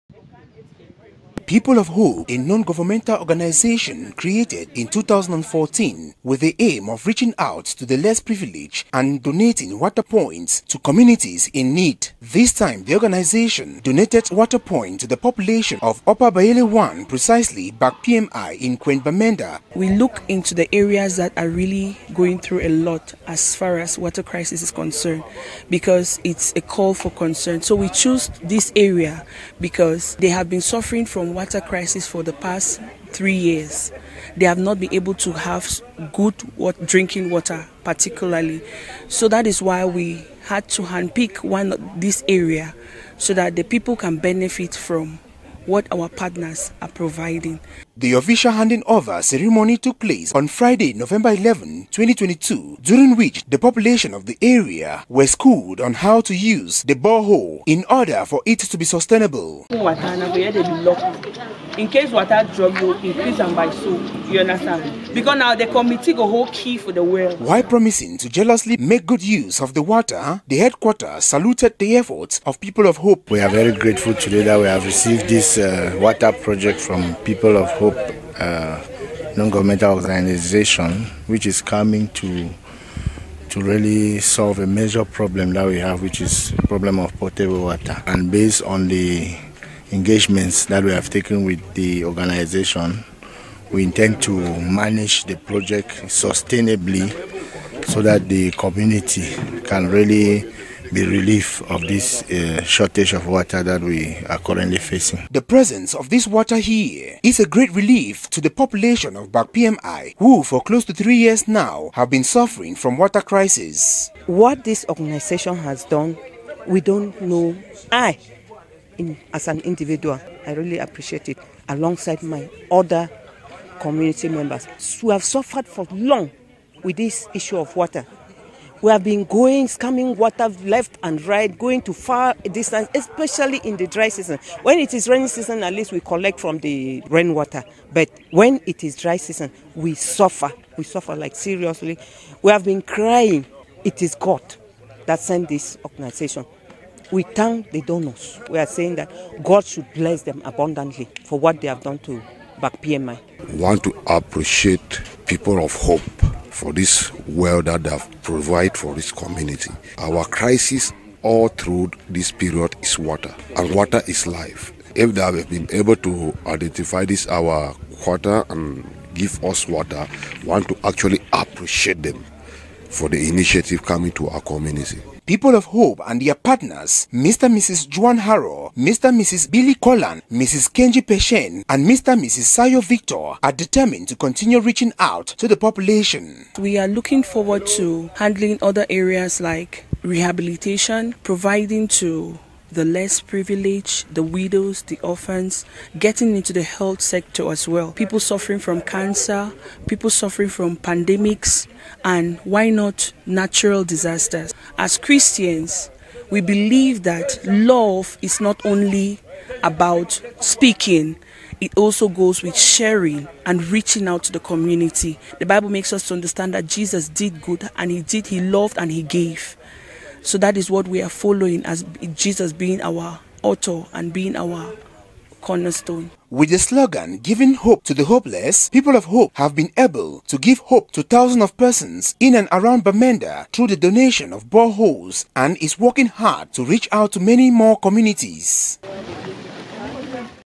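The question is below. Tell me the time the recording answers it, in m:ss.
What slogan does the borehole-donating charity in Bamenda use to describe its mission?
3:47.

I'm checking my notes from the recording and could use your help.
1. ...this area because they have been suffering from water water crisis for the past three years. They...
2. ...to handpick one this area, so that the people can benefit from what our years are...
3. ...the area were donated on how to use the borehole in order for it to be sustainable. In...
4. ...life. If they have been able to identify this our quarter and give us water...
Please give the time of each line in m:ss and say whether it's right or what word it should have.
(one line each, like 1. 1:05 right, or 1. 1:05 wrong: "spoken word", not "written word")
1. 0:28 right
2. 0:40 wrong: "partners", not "years"
3. 0:54 wrong: "schooled", not "donated"
4. 2:44 right.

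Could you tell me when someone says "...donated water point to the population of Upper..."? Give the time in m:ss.
0:13.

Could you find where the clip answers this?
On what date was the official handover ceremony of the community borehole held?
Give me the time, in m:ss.
0:50.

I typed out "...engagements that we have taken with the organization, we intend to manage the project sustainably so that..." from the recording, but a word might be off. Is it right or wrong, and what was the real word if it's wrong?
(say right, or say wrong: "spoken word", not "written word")
right.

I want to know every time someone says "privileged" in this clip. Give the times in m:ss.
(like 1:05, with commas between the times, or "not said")
0:08, 3:13.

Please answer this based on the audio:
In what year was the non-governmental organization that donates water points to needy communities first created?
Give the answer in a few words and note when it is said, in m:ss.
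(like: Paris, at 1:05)
2014, at 0:04.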